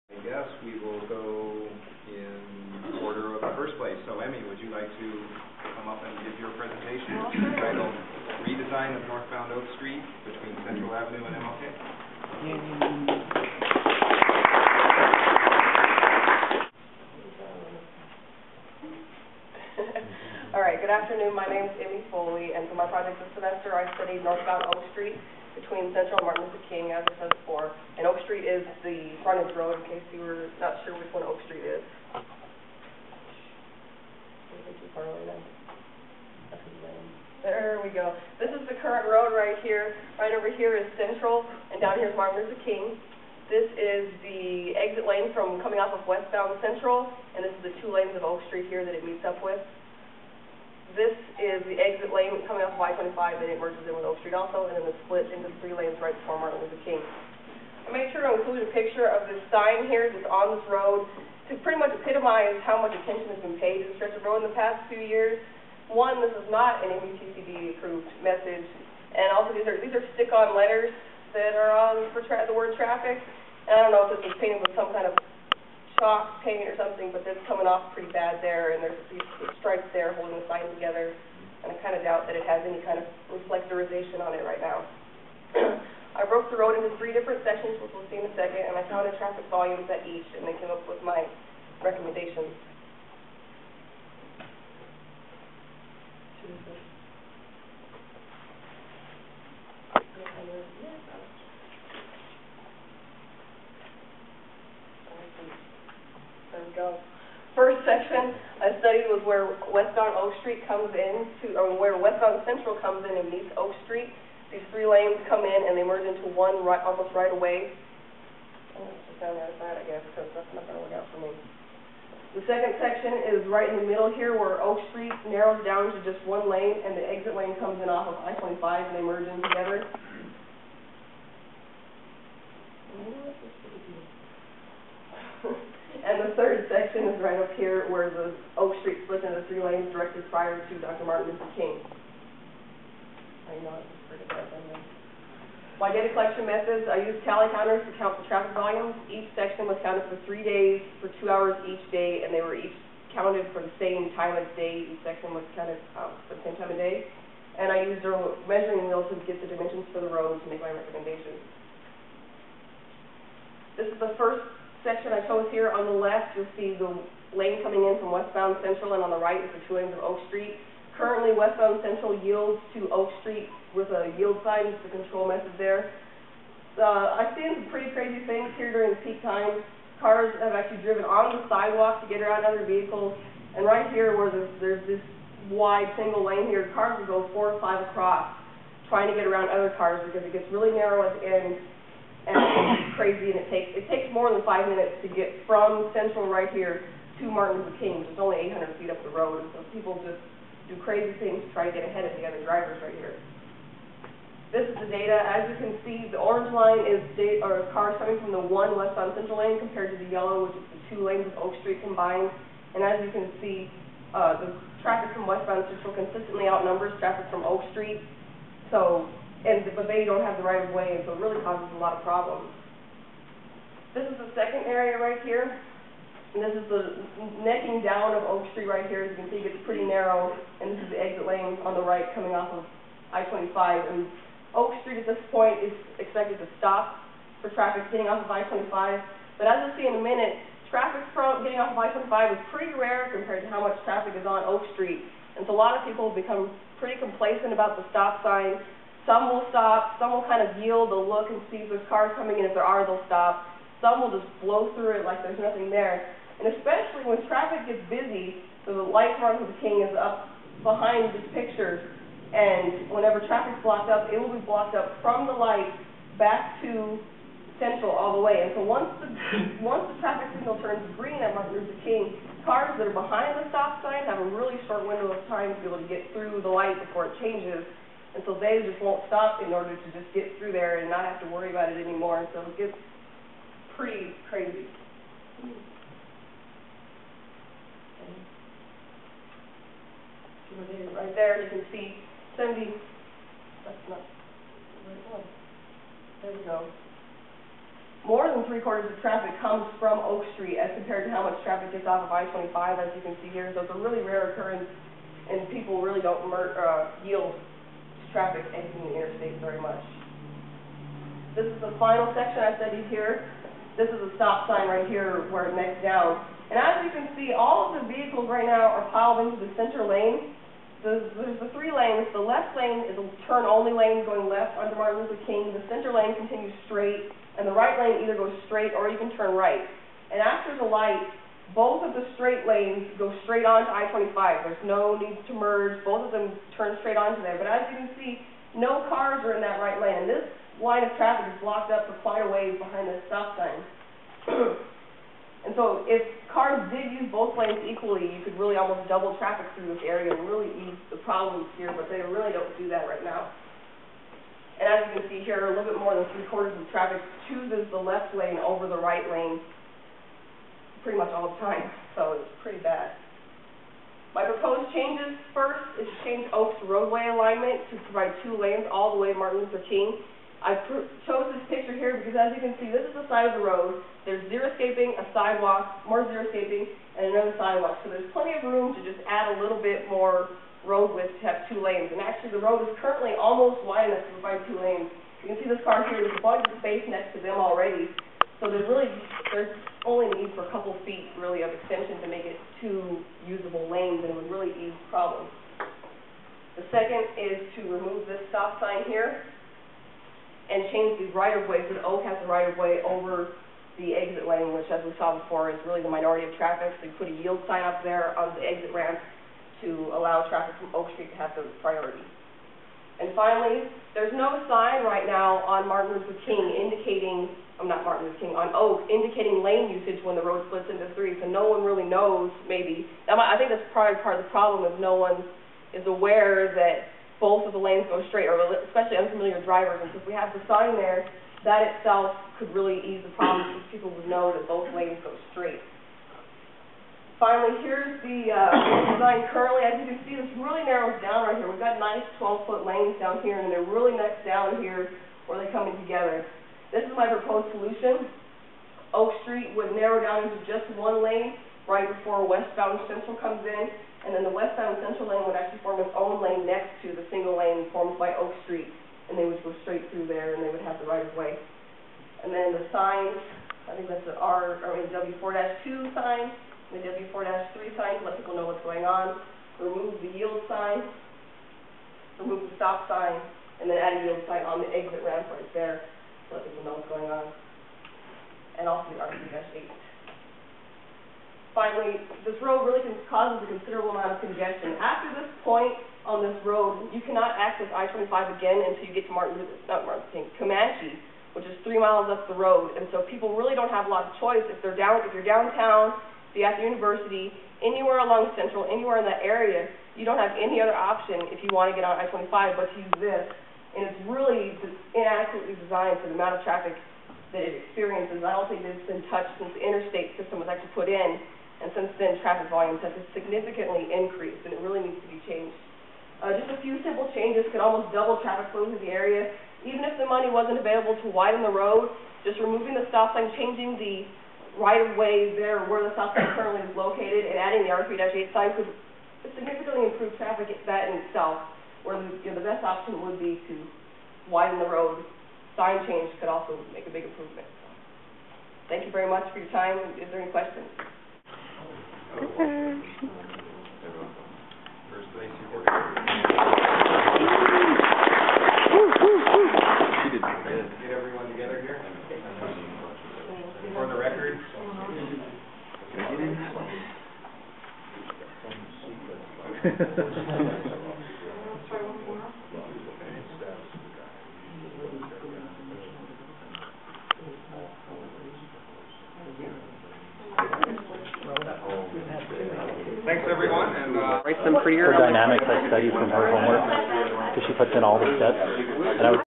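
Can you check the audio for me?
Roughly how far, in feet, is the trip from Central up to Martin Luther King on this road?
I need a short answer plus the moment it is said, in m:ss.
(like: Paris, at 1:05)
800 feet, at 3:18.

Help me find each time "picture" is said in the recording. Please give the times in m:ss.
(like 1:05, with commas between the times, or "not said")
0:58, 4:21, 6:11.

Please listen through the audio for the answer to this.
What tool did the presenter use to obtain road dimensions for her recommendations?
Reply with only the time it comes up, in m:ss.
2:38.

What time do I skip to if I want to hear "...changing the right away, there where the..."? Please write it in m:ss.
8:43.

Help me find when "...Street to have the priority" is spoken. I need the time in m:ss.
6:50.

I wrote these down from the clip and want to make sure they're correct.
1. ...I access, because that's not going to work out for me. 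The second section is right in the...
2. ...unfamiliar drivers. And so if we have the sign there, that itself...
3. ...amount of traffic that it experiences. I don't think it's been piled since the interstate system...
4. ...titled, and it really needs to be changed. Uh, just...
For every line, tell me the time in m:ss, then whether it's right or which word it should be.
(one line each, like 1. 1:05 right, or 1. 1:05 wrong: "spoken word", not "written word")
1. 1:59 wrong: "guess", not "access"
2. 7:09 right
3. 8:26 wrong: "touched", not "piled"
4. 8:33 wrong: "increased", not "titled".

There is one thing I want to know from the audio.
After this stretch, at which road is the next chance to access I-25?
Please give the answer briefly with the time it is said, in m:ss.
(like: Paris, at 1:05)
Comanche, at 8:10.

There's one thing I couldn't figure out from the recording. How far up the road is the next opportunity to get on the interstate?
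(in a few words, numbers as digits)
3 miles.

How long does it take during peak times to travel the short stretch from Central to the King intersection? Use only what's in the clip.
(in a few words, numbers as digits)
More than 5 minutes.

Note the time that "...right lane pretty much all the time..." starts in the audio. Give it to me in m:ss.
5:58.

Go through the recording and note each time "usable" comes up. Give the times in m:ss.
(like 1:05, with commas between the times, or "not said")
6:33.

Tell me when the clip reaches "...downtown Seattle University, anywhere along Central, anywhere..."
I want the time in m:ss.
8:15.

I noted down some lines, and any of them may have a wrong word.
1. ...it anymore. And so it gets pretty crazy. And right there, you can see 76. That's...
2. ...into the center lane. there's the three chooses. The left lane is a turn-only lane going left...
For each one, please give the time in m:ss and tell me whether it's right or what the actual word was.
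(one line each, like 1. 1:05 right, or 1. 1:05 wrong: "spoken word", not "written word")
1. 4:41 wrong: "70", not "76"
2. 5:19 wrong: "lanes", not "chooses".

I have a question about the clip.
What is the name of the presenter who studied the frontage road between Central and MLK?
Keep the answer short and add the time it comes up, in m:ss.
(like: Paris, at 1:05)
Emmy Foley, at 0:21.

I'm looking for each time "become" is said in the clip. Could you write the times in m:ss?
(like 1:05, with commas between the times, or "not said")
4:06.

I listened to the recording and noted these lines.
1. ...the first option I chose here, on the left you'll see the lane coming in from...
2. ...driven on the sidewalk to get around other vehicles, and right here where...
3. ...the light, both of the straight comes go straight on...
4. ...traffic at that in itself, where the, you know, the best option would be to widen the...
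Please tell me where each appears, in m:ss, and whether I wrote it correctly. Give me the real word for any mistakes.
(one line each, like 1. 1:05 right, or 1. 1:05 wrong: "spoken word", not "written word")
1. 2:44 wrong: "section", not "option"
2. 3:00 right
3. 5:30 wrong: "lanes", not "comes"
4. 8:50 right.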